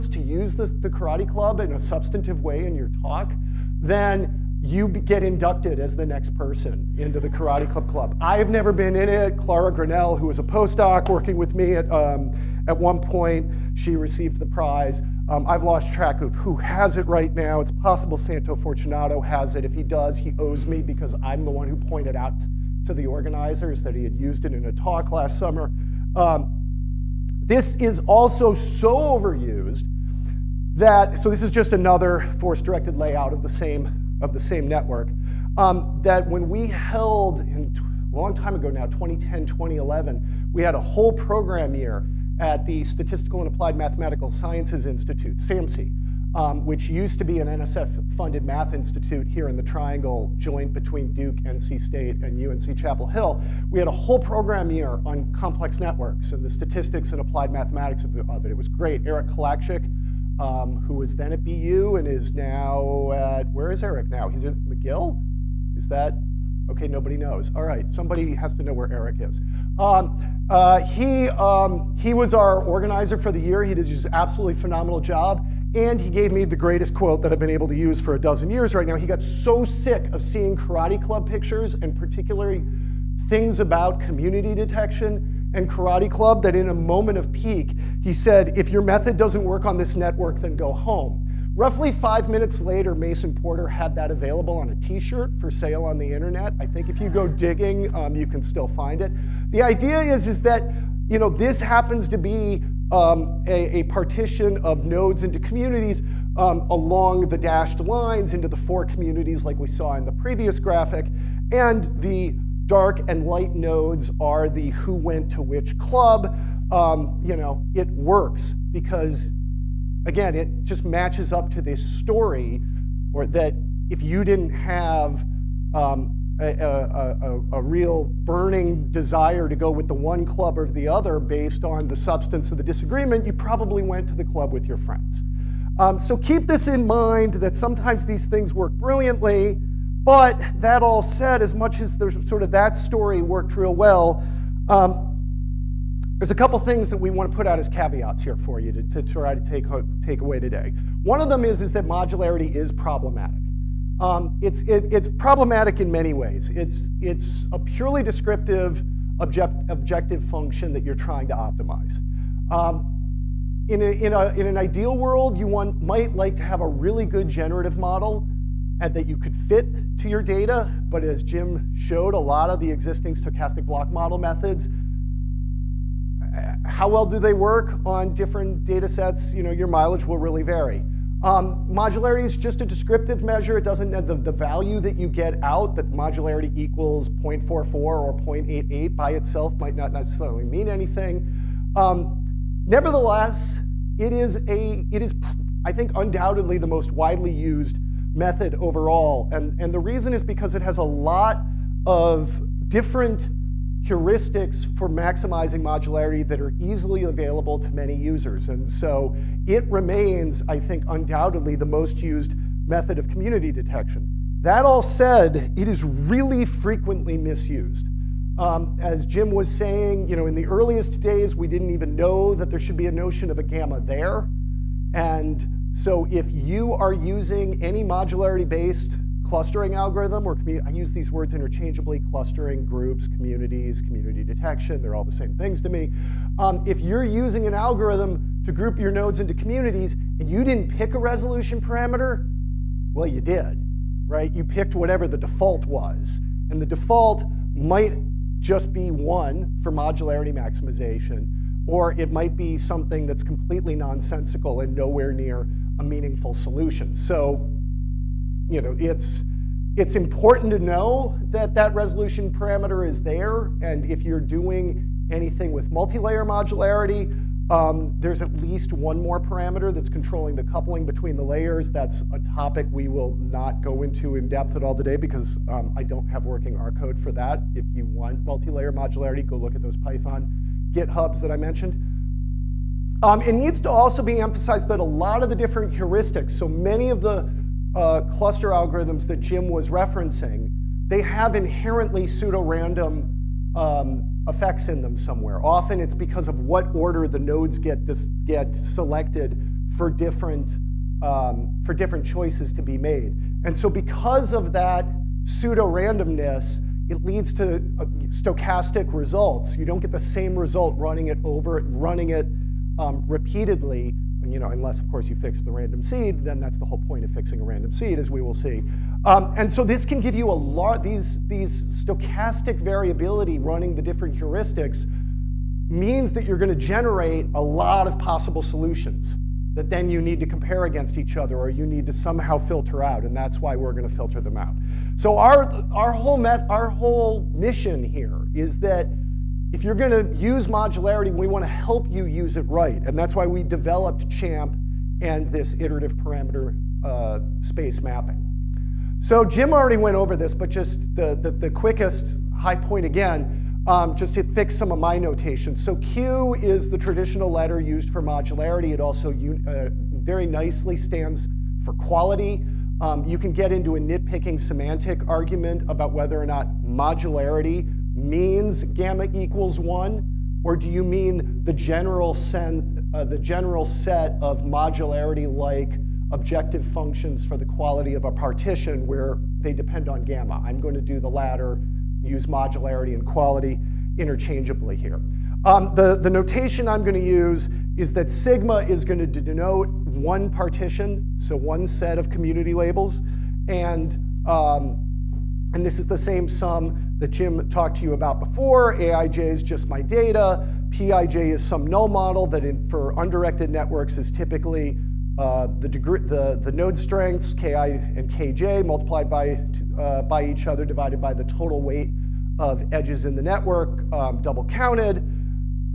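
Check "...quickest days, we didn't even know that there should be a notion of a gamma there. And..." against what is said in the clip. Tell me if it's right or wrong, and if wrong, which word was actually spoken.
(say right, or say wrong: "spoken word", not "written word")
wrong: "earliest", not "quickest".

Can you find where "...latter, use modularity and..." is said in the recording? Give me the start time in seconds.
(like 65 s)
381 s.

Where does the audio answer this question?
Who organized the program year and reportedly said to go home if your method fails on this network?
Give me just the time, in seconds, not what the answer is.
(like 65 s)
59 s.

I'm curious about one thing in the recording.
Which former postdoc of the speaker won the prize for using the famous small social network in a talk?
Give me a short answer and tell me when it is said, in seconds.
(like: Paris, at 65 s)
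Clara Granell, at 9 s.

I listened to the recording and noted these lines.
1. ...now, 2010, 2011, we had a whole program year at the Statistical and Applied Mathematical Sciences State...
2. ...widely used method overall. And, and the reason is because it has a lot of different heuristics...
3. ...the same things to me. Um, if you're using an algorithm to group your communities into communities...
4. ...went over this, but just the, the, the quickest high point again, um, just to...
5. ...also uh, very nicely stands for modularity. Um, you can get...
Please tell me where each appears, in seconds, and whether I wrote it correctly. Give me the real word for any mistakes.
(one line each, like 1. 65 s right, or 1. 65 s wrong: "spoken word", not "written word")
1. 38 s wrong: "Institute", not "State"
2. 196 s right
3. 235 s wrong: "nodes", not "communities"
4. 349 s right
5. 358 s wrong: "quality", not "modularity".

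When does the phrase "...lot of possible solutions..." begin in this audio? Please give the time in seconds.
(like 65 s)
327 s.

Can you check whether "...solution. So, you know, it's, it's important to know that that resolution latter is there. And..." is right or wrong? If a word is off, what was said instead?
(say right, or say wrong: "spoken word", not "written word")
wrong: "parameter", not "latter".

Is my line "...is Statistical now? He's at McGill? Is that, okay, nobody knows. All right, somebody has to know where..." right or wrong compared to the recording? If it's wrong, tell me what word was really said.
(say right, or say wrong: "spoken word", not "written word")
wrong: "Eric", not "Statistical".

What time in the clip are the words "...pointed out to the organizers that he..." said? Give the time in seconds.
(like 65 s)
21 s.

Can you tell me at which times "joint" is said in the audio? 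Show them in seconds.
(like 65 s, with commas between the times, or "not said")
50 s.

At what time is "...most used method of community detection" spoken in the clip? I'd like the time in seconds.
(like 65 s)
211 s.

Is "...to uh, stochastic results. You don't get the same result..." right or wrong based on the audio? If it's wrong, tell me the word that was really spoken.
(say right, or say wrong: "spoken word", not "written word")
right.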